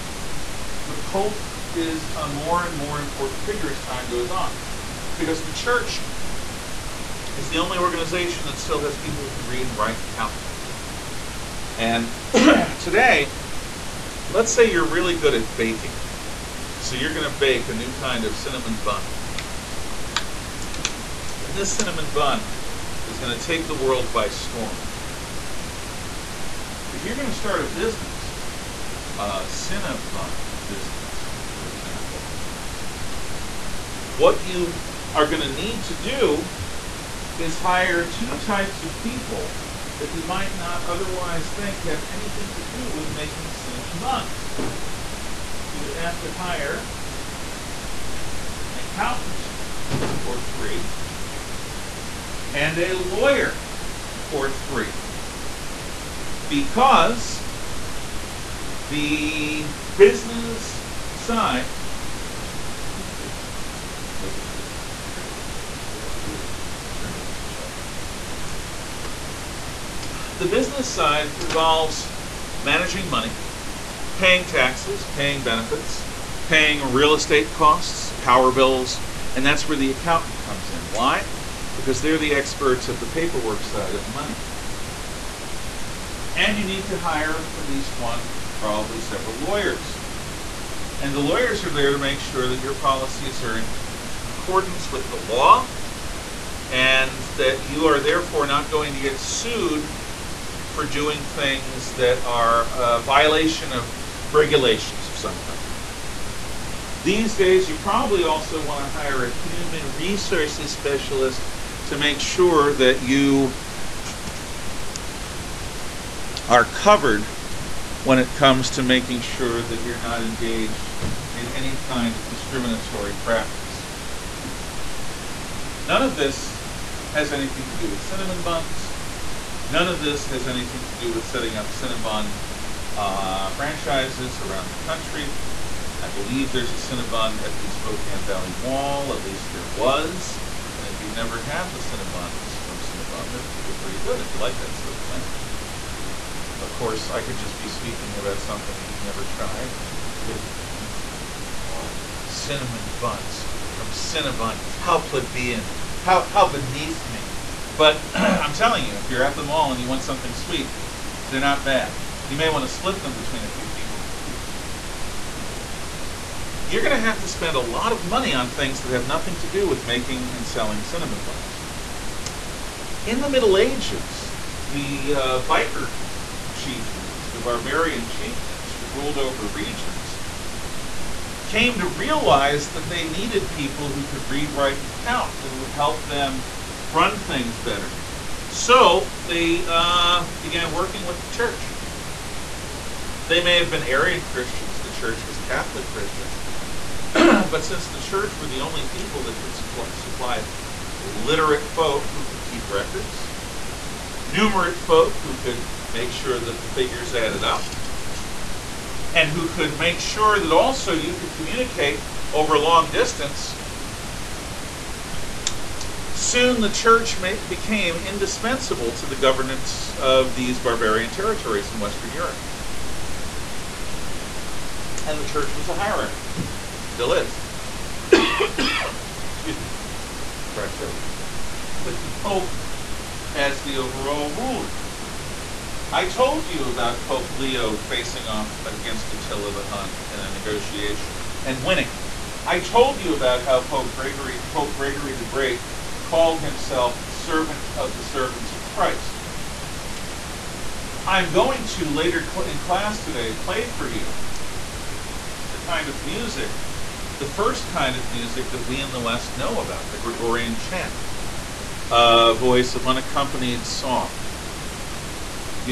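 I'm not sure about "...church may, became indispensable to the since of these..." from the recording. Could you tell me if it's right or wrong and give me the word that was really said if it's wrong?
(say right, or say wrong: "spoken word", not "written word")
wrong: "governance", not "since".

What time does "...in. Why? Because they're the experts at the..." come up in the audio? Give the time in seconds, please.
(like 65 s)
80 s.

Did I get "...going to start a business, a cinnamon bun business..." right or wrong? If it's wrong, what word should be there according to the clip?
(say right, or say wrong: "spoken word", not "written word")
right.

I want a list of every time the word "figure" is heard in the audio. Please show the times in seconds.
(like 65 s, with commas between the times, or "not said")
3 s, 206 s.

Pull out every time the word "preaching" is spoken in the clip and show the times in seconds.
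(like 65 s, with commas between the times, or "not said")
not said.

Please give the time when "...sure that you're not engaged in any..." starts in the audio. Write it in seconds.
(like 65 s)
119 s.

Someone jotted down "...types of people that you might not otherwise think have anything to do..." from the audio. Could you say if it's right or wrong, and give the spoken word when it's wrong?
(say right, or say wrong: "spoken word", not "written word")
right.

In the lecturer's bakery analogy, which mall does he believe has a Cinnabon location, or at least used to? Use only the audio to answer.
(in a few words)
Spokane Valley Mall.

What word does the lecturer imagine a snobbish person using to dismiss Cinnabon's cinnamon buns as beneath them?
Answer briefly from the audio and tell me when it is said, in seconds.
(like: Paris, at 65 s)
plebeian, at 155 s.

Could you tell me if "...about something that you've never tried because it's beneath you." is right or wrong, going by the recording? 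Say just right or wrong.
right.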